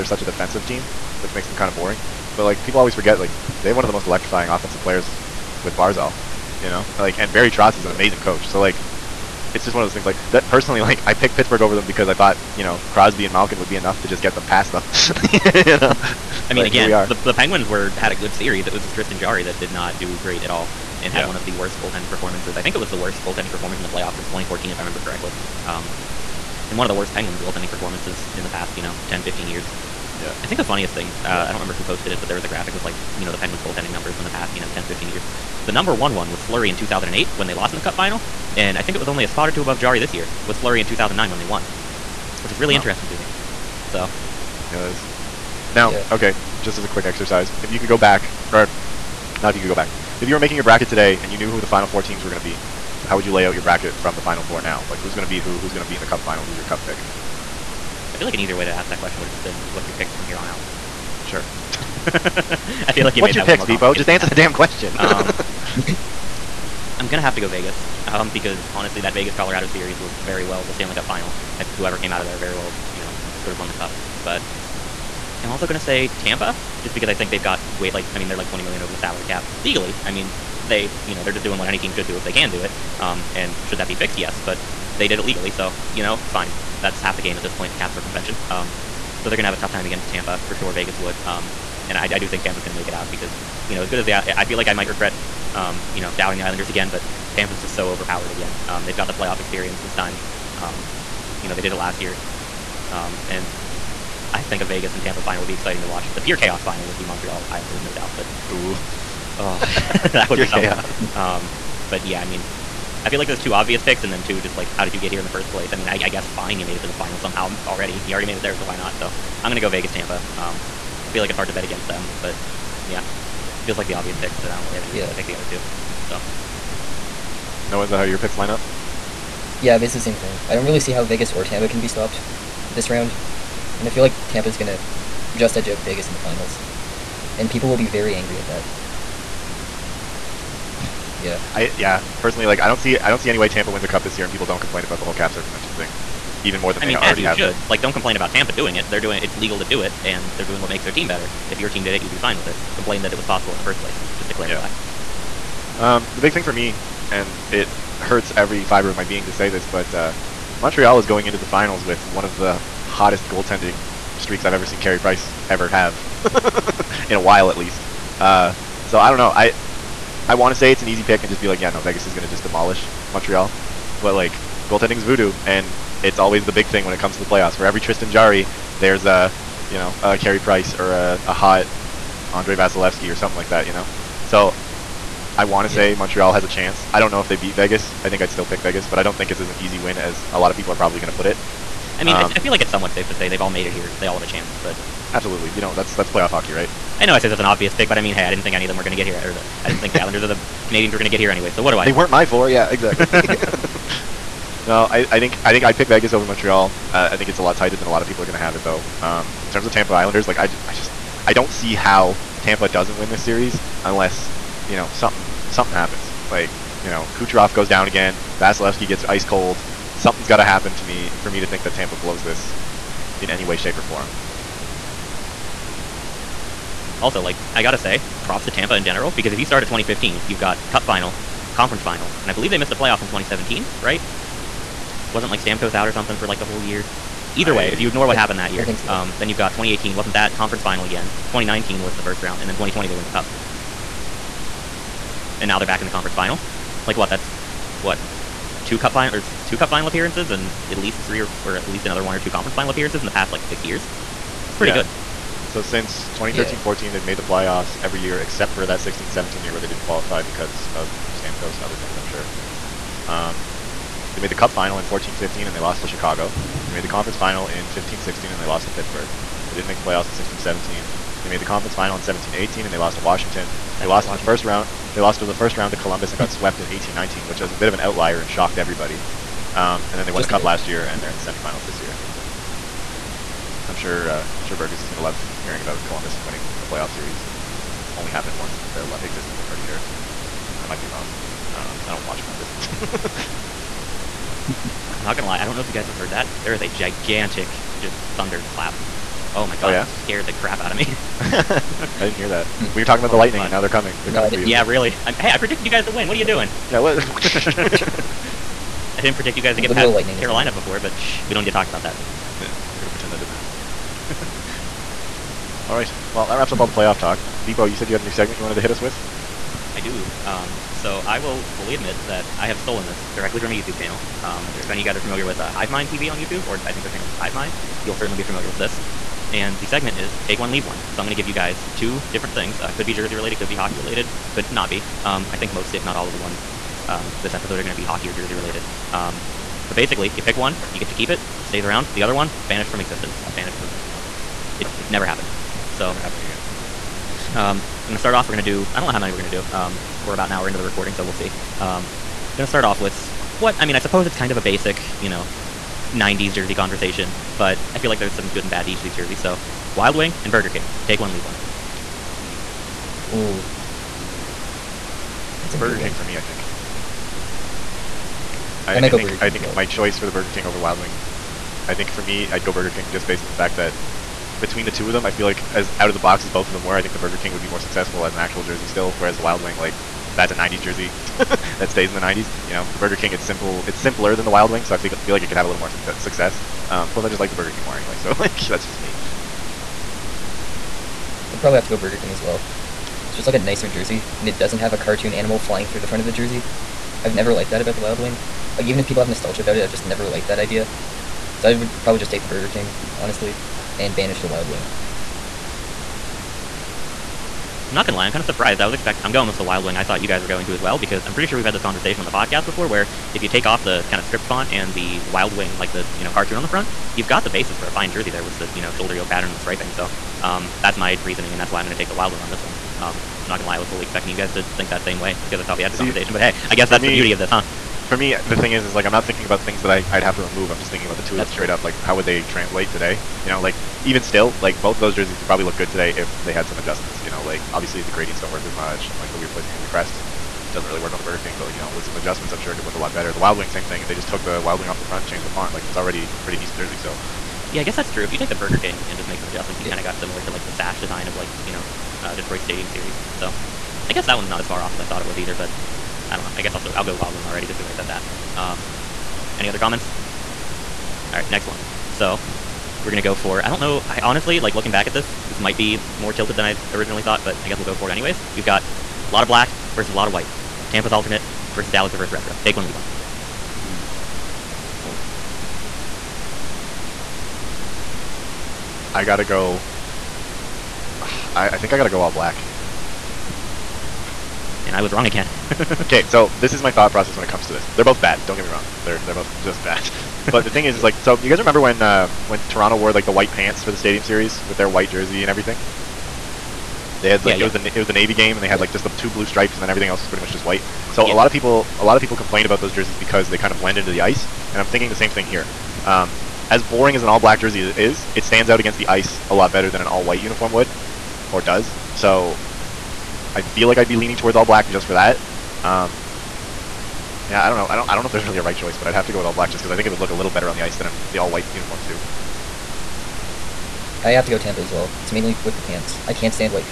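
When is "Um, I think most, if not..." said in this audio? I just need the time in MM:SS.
05:35.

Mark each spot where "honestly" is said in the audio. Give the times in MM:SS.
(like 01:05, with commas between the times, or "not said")
01:08, 06:42, 07:44.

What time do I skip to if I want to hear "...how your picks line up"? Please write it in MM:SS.
02:07.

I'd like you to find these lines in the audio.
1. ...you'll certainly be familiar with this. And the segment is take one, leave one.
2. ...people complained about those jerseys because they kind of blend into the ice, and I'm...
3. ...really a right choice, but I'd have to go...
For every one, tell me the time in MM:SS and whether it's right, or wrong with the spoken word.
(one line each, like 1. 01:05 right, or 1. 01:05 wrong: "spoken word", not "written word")
1. 05:27 right
2. 08:21 right
3. 08:38 right.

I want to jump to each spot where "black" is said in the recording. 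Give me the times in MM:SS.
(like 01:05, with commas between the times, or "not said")
07:49, 08:02, 08:27, 08:34, 08:39.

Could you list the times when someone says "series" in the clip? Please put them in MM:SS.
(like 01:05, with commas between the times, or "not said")
00:18, 01:09, 03:33, 04:46, 07:32, 08:14.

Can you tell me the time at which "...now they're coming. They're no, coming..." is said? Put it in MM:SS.
05:03.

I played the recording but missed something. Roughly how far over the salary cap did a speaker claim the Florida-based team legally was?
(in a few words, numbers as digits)
20 million.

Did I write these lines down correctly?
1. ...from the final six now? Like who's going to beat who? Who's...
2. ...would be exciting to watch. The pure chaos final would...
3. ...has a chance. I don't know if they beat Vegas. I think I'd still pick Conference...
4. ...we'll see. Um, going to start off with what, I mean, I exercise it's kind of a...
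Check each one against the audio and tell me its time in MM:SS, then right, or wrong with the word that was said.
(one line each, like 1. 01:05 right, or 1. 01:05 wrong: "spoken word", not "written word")
1. 00:53 wrong: "four", not "six"
2. 01:45 right
3. 03:06 wrong: "Vegas", not "Conference"
4. 05:51 wrong: "suppose", not "exercise".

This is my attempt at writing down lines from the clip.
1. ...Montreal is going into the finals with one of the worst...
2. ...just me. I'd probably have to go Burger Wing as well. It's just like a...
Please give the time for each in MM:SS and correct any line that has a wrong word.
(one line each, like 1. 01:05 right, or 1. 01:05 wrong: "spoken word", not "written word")
1. 02:40 wrong: "hottest", not "worst"
2. 06:28 wrong: "King", not "Wing".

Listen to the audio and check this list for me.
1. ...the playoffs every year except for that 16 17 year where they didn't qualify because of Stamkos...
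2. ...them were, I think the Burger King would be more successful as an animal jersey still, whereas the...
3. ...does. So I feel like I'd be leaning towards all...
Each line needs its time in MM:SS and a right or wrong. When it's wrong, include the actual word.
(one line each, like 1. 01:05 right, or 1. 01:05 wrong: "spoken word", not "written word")
1. 04:17 right
2. 06:16 wrong: "actual", not "animal"
3. 08:31 right.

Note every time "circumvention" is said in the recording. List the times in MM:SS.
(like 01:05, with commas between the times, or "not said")
01:27, 02:25.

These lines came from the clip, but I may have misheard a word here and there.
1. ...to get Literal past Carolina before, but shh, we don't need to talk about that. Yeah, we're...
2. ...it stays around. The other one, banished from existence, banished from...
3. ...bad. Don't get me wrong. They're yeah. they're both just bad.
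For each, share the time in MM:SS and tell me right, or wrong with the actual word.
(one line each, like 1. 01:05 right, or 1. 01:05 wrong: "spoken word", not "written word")
1. 05:09 right
2. 05:41 right
3. 08:07 right.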